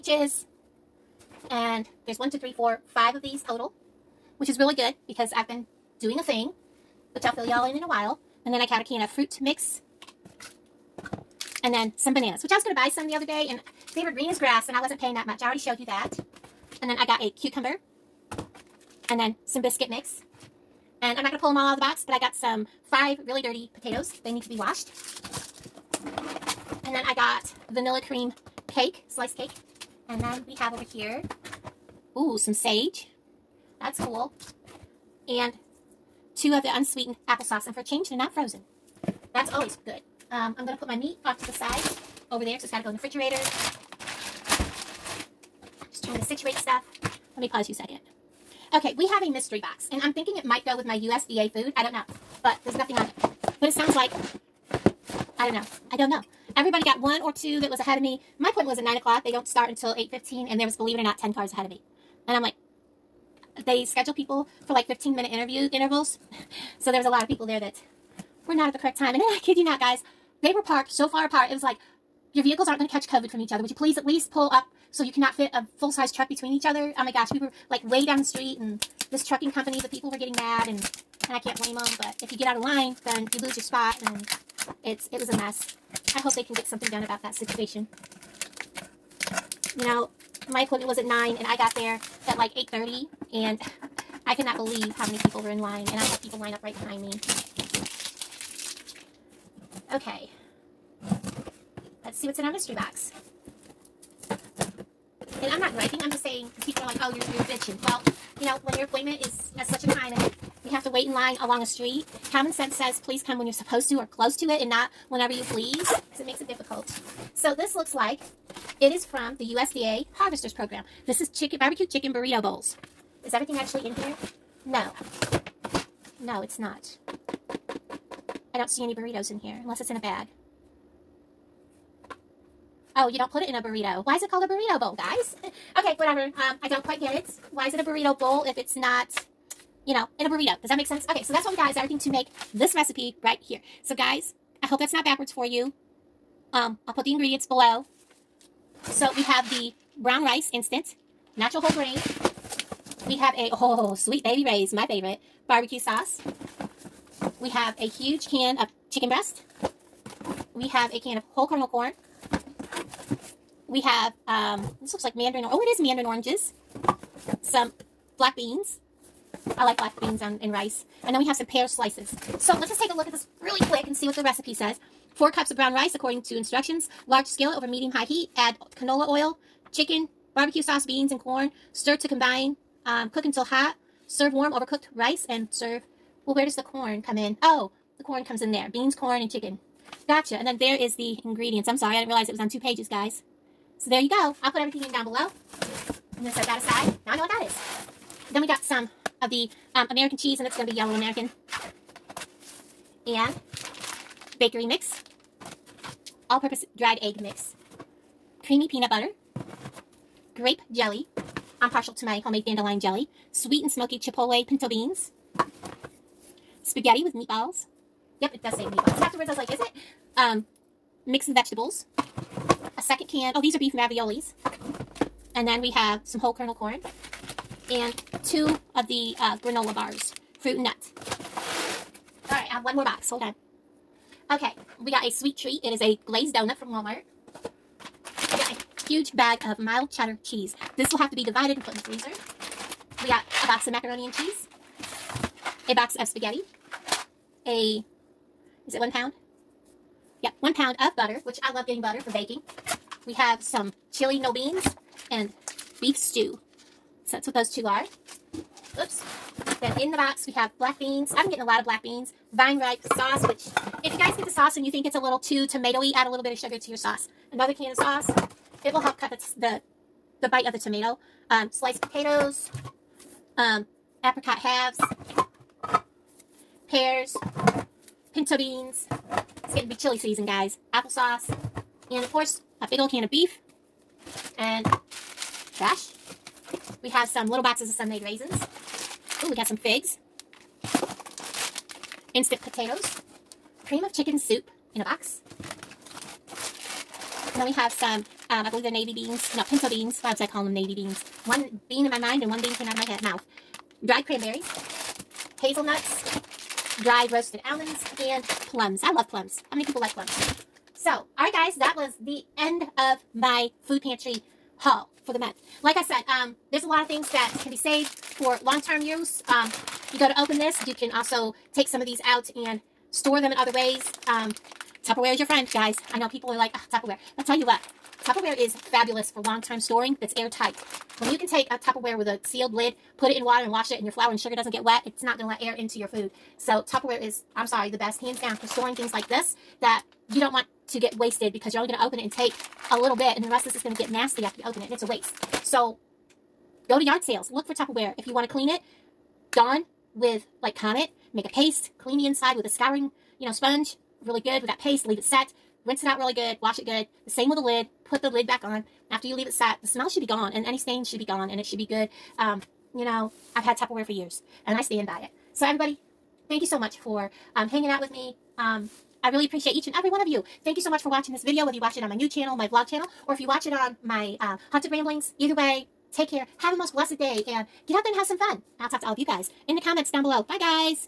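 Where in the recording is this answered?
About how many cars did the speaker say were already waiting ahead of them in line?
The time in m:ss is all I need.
1:01.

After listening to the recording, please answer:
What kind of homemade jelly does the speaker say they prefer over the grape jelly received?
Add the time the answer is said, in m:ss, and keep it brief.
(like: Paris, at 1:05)
Dandelion jelly, at 3:32.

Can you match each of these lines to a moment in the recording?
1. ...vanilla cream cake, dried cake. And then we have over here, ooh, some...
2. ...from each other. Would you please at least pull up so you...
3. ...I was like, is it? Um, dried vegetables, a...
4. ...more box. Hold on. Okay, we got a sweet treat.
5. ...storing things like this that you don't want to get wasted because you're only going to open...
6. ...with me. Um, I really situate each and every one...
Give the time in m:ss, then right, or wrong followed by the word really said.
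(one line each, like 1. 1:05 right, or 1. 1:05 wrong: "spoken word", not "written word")
1. 0:27 wrong: "sliced", not "dried"
2. 1:13 right
3. 3:39 wrong: "mixed", not "dried"
4. 3:52 right
5. 5:38 right
6. 6:07 wrong: "appreciate", not "situate".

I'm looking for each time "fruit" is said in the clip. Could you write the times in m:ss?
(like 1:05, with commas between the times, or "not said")
0:09, 3:50.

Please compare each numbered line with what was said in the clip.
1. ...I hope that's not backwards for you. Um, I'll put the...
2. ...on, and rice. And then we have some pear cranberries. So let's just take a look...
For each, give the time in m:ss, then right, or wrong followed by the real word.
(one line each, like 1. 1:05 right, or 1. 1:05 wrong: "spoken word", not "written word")
1. 2:24 right
2. 2:50 wrong: "slices", not "cranberries".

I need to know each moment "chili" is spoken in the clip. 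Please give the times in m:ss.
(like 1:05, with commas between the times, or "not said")
4:13, 4:39.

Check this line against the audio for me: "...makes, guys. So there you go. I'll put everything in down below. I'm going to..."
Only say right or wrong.
wrong.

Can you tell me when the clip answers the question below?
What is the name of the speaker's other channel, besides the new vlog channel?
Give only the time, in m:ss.
6:14.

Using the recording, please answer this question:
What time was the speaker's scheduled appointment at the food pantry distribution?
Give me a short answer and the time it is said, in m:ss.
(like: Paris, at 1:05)
9 o'clock, at 0:58.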